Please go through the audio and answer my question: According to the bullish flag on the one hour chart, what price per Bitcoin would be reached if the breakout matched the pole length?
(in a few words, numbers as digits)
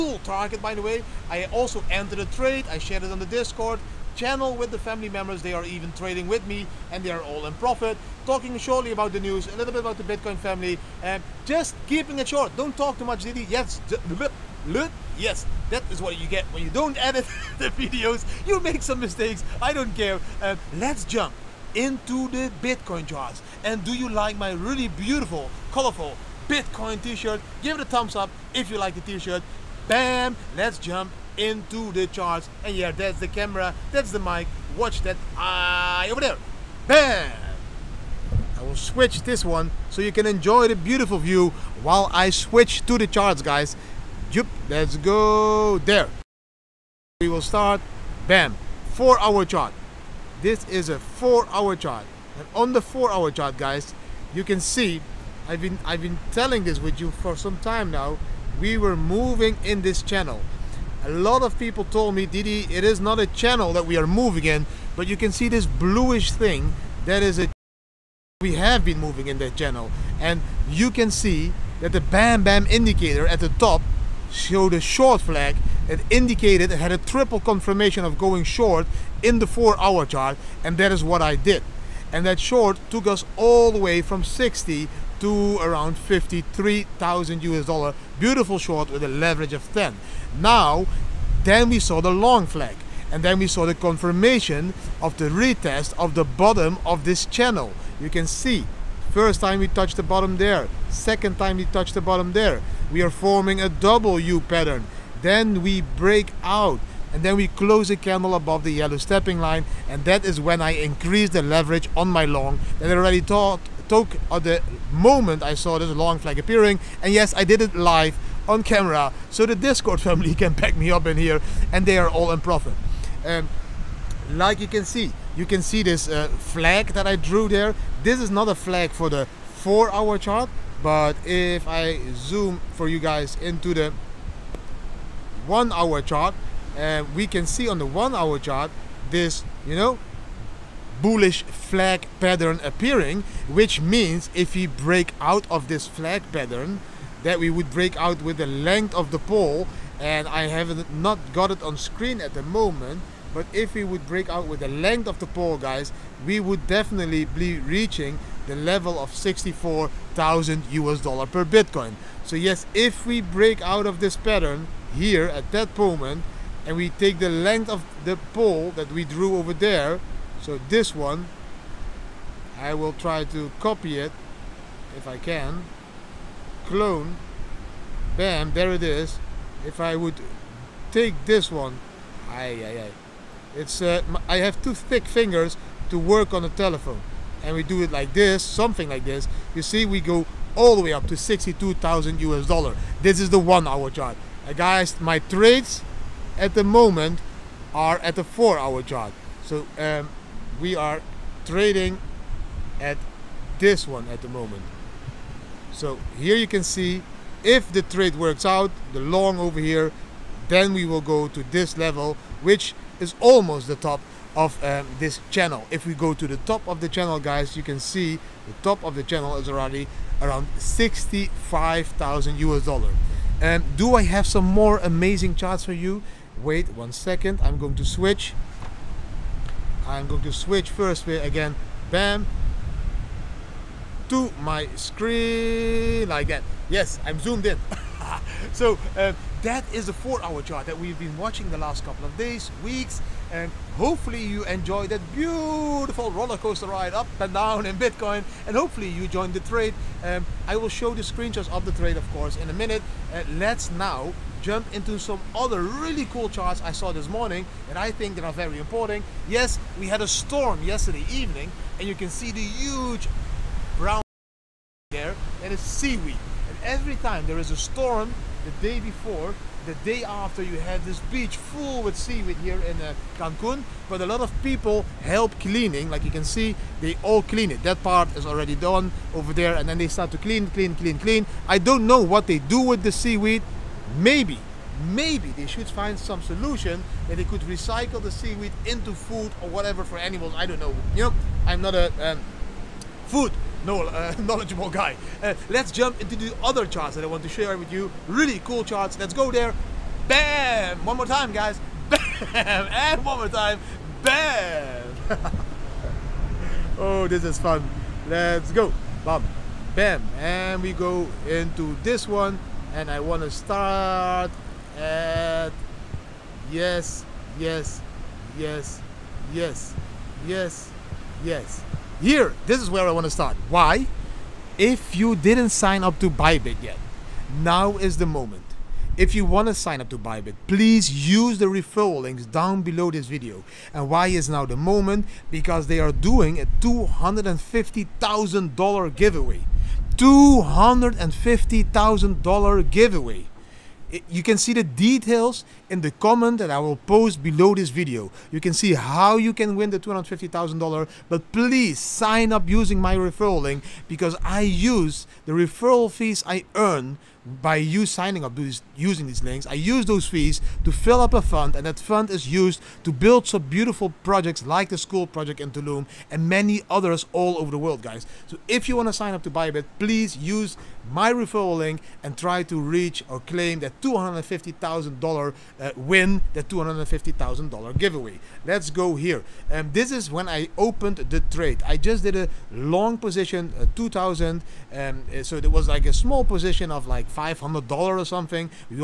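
$64,000.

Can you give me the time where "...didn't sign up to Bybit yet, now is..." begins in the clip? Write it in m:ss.
5:25.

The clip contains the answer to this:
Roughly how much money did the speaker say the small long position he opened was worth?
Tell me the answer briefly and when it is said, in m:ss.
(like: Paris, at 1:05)
$500, at 6:27.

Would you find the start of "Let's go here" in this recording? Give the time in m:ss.
6:18.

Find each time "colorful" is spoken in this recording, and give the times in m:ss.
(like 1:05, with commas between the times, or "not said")
0:25.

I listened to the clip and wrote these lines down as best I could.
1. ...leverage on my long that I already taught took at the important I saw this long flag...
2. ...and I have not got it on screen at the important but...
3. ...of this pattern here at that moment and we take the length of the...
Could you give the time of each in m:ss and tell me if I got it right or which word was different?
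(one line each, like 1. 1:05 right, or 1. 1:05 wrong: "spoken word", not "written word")
1. 1:51 wrong: "moment", not "important"
2. 2:29 wrong: "moment", not "important"
3. 2:43 right.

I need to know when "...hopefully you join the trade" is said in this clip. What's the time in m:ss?
4:08.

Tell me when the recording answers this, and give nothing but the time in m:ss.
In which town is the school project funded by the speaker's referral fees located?
6:05.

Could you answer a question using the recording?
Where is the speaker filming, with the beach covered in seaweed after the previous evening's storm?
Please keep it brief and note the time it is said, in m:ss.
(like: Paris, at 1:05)
Cancun, at 4:33.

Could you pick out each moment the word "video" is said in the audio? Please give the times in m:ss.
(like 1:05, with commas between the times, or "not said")
0:17, 5:33, 5:47.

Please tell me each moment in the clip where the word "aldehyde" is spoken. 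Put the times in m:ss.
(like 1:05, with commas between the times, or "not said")
not said.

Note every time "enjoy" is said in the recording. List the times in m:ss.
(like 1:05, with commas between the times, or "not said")
0:40, 4:04.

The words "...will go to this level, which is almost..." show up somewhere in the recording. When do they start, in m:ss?
3:30.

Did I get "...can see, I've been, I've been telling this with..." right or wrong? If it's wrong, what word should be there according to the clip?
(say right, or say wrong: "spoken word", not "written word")
right.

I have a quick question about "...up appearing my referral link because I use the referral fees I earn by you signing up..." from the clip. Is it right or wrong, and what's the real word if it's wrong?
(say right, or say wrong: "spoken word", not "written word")
wrong: "using", not "appearing".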